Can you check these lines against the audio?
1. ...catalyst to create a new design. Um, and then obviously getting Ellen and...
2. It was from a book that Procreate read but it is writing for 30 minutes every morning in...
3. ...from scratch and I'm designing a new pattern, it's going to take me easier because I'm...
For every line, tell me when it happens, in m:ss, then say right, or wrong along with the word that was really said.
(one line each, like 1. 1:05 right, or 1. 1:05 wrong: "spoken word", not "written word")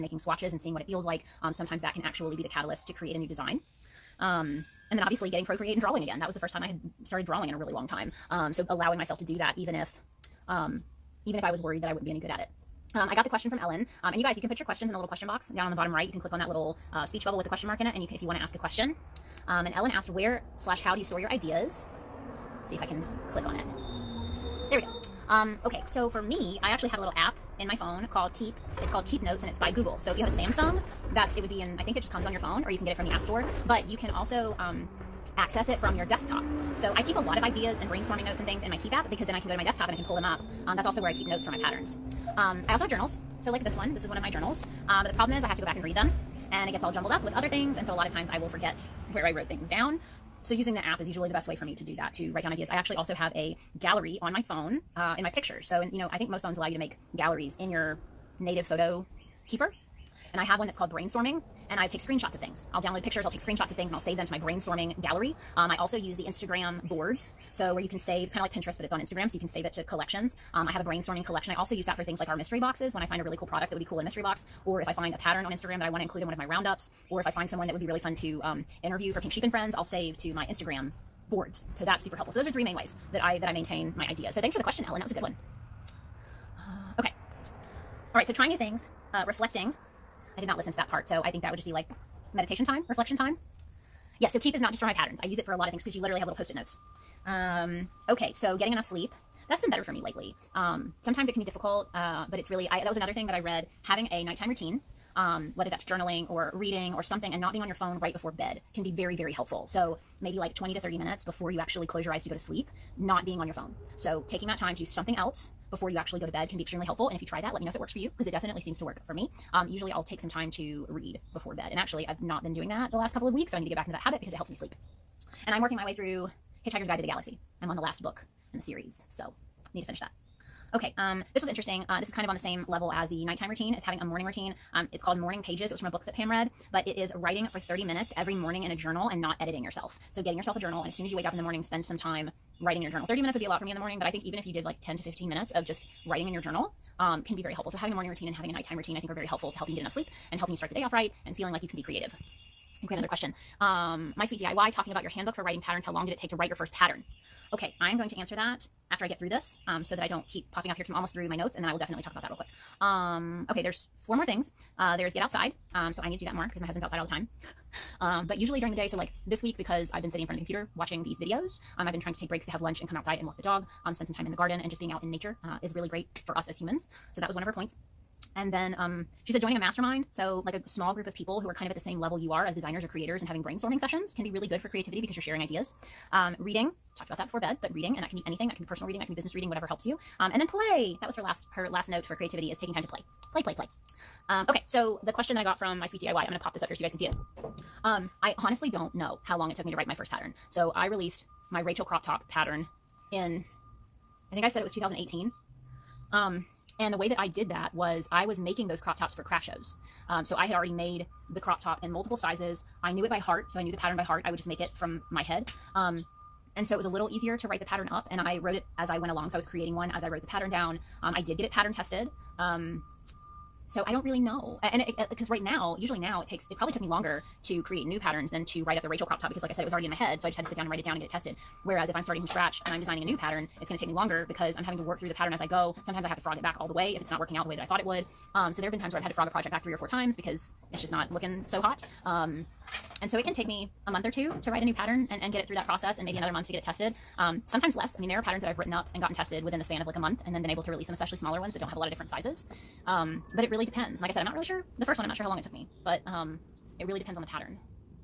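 1. 0:02 wrong: "Procreate", not "Ellen"
2. 2:15 wrong: "Pam", not "Procreate"
3. 3:52 wrong: "longer", not "easier".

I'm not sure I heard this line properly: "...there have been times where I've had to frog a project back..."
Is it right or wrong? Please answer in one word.
right.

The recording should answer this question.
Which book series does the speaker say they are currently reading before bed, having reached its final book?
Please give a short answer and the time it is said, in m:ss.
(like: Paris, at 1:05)
Hitchhiker's Guide to the Galaxy, at 2:06.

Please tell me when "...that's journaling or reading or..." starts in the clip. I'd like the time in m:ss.
1:45.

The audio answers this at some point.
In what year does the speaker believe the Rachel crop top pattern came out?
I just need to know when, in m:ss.
3:24.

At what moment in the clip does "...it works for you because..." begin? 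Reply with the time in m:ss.
1:57.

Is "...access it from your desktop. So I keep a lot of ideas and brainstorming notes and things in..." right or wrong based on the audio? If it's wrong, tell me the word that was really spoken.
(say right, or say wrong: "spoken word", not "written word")
right.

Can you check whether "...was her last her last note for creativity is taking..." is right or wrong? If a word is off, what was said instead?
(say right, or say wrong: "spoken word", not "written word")
right.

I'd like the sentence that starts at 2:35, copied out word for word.
How long did it take to write your first pattern?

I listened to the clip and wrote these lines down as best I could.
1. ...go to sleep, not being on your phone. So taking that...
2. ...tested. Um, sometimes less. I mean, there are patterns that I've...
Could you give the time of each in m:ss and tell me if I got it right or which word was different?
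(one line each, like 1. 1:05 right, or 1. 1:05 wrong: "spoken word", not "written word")
1. 1:52 right
2. 4:06 right.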